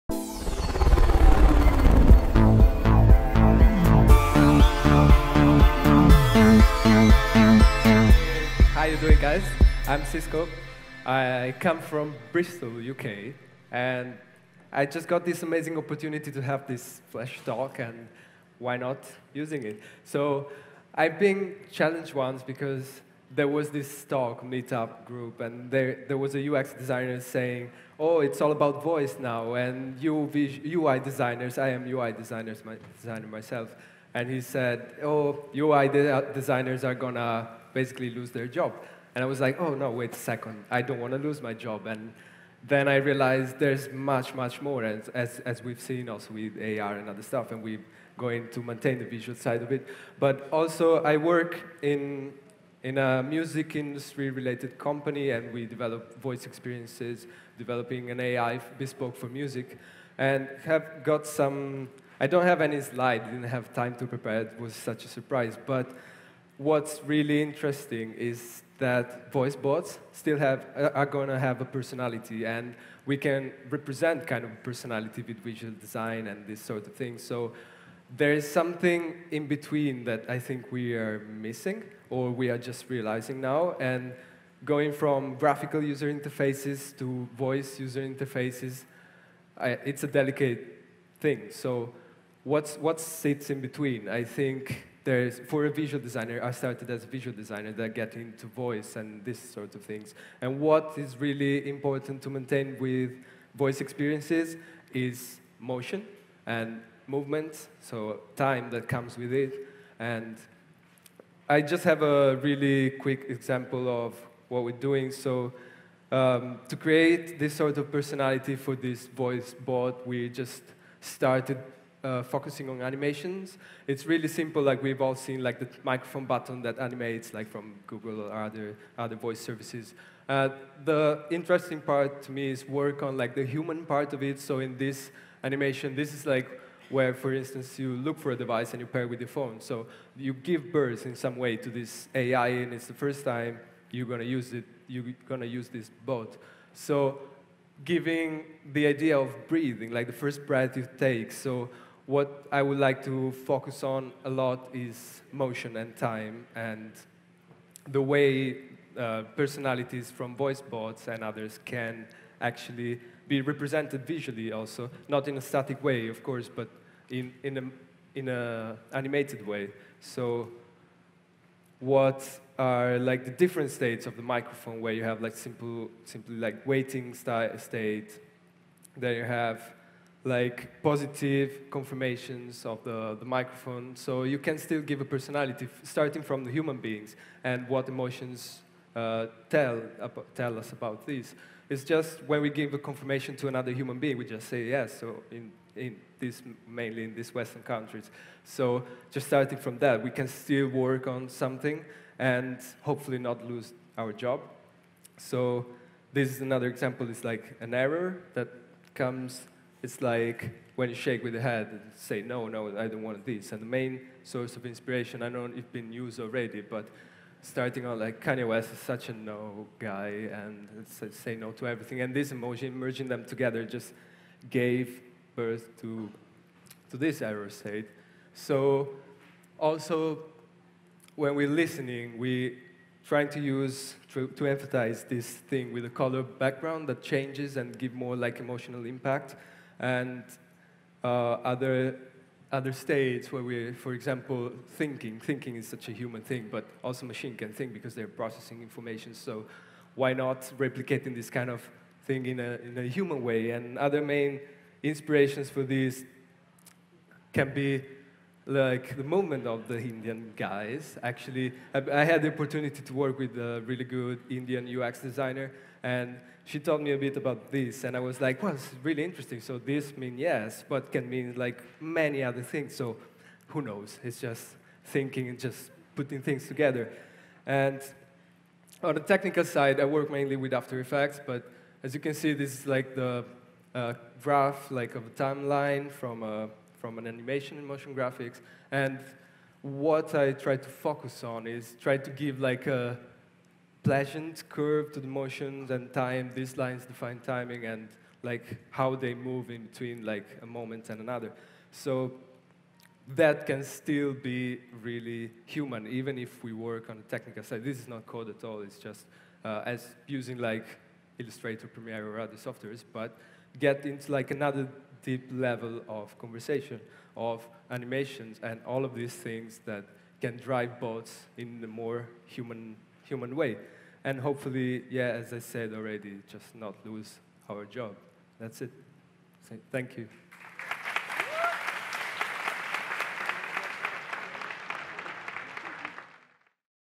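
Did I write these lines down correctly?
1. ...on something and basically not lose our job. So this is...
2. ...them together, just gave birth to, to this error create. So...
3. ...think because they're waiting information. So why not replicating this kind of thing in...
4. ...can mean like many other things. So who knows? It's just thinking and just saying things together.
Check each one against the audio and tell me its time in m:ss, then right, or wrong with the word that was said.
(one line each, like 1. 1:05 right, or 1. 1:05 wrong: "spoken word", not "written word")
1. 3:21 wrong: "hopefully", not "basically"
2. 3:43 wrong: "state", not "create"
3. 4:07 wrong: "processing", not "waiting"
4. 4:30 wrong: "putting", not "saying".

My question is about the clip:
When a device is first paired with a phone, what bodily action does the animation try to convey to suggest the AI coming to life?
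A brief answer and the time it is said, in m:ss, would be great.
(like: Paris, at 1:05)
breathing, at 2:29.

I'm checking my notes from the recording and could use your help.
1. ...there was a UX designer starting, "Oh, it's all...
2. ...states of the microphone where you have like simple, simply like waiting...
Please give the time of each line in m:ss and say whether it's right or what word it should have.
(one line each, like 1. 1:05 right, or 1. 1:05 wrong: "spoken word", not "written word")
1. 0:26 wrong: "saying", not "starting"
2. 2:53 right.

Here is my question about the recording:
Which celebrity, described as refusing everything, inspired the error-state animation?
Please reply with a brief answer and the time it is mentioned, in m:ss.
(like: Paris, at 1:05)
Kanye West, at 3:38.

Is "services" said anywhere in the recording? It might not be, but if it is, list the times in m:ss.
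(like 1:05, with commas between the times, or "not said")
2:09.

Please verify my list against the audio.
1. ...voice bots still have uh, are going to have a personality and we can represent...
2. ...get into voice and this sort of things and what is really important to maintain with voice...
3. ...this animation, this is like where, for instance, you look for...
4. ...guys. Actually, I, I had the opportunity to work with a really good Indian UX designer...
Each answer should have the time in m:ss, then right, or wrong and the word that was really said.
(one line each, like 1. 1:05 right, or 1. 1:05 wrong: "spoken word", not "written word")
1. 1:09 right
2. 1:37 right
3. 2:14 right
4. 4:20 right.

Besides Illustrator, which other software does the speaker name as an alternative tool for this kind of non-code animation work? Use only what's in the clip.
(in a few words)
Premiere.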